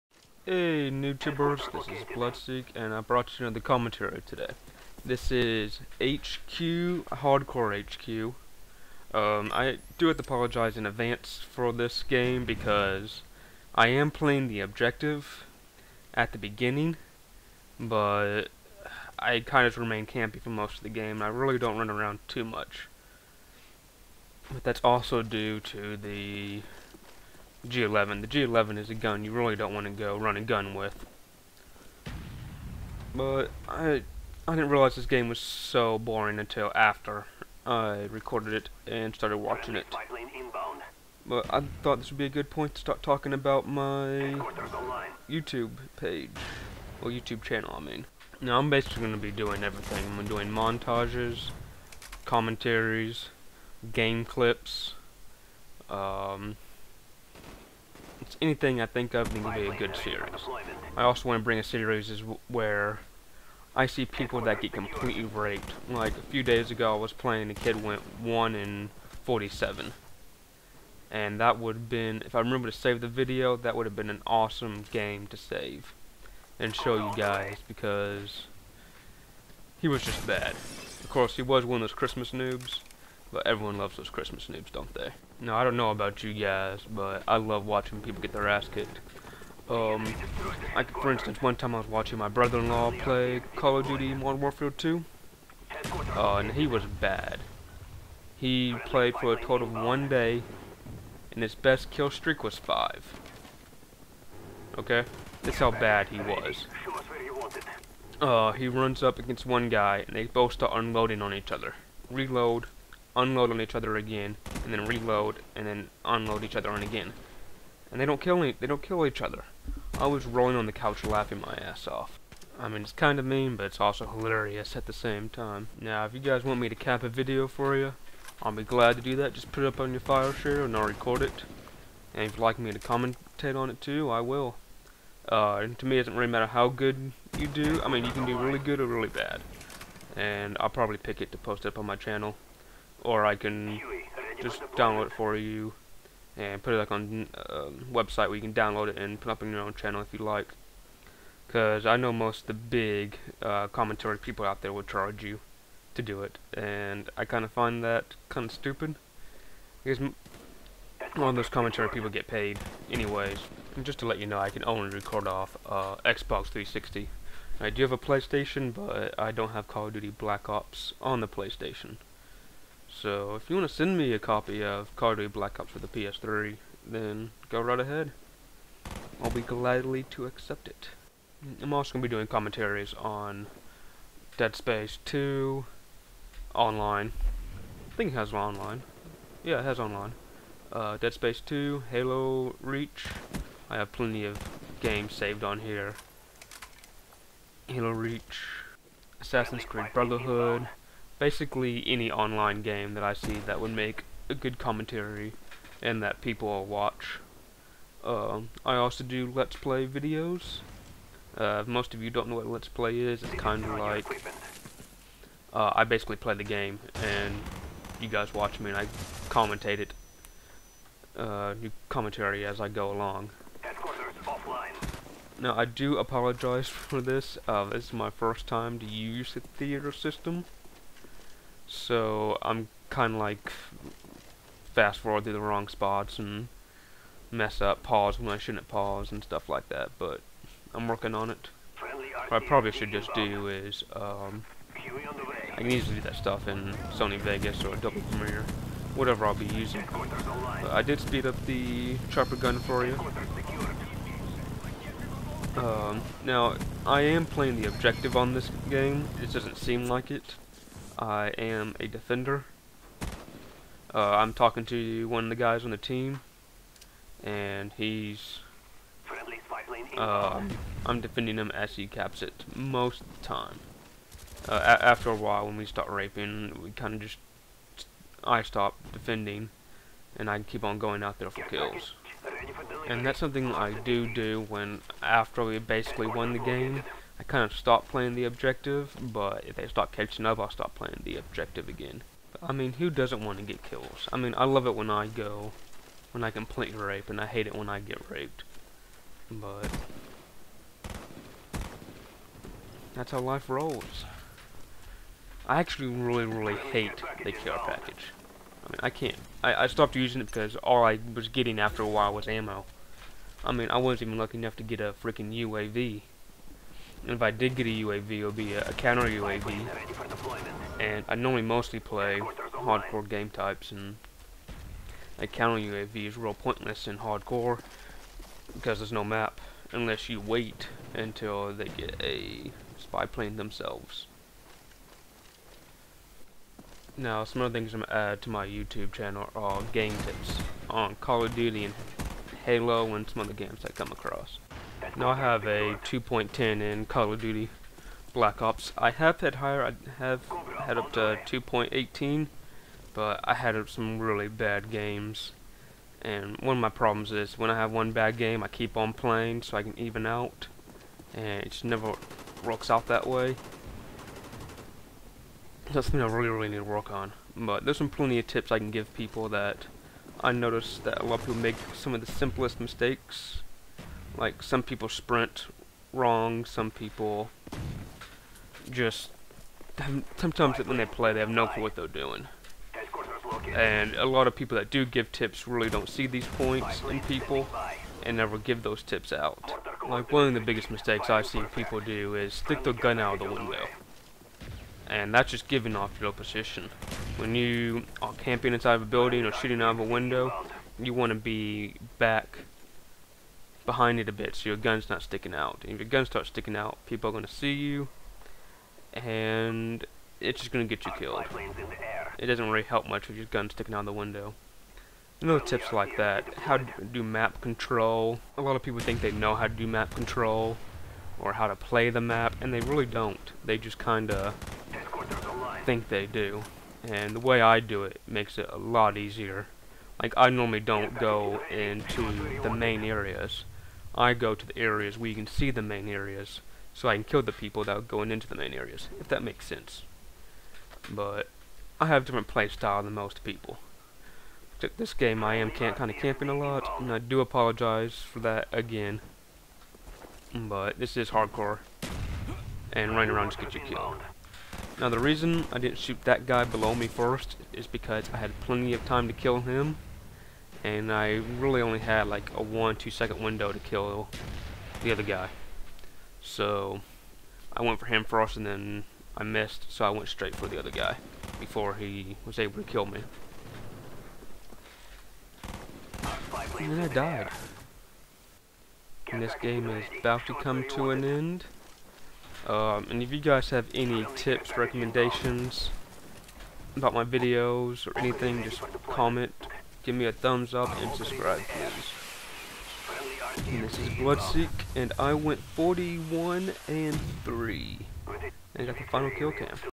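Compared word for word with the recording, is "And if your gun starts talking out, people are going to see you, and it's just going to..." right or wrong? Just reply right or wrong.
wrong.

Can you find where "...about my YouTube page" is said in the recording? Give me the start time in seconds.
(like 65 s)
43 s.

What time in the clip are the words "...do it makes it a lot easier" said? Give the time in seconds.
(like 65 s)
427 s.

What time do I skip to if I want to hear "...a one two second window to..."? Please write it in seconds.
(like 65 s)
462 s.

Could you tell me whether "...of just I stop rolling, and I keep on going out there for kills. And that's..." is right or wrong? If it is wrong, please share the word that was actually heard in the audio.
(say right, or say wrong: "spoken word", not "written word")
wrong: "defending", not "rolling".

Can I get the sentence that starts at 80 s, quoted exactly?
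Of course he was one of those Christmas noobs.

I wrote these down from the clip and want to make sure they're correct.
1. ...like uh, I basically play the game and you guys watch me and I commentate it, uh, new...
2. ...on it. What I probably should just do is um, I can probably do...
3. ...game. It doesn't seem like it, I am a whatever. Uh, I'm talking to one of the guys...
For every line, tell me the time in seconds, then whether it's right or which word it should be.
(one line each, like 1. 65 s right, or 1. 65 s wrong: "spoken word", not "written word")
1. 213 s right
2. 241 s wrong: "easily", not "probably"
3. 258 s wrong: "defender", not "whatever".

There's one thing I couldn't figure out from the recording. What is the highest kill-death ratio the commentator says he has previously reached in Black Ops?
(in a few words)
2.18.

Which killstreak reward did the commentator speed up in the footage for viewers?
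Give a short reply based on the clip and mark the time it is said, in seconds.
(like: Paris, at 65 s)
Chopper gun, at 252 s.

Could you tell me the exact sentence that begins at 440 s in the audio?
But, I have a different playstyle than most people.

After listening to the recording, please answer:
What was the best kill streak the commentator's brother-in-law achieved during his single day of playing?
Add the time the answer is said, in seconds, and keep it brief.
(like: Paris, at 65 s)
5, at 102 s.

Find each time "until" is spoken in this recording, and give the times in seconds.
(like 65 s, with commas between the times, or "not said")
36 s, 330 s.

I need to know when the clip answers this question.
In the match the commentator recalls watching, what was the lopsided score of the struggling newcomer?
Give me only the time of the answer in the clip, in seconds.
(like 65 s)
68 s.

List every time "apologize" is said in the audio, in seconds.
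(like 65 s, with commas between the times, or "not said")
10 s, 225 s, 447 s.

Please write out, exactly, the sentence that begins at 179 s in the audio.
I'll be gladly to accept it.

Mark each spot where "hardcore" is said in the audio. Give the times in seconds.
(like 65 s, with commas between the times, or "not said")
7 s, 322 s, 326 s, 451 s.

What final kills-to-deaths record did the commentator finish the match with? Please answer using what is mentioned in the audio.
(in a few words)
41 and 3.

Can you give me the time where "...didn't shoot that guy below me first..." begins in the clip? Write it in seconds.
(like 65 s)
455 s.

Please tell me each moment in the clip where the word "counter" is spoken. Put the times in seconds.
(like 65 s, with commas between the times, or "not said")
318 s, 325 s.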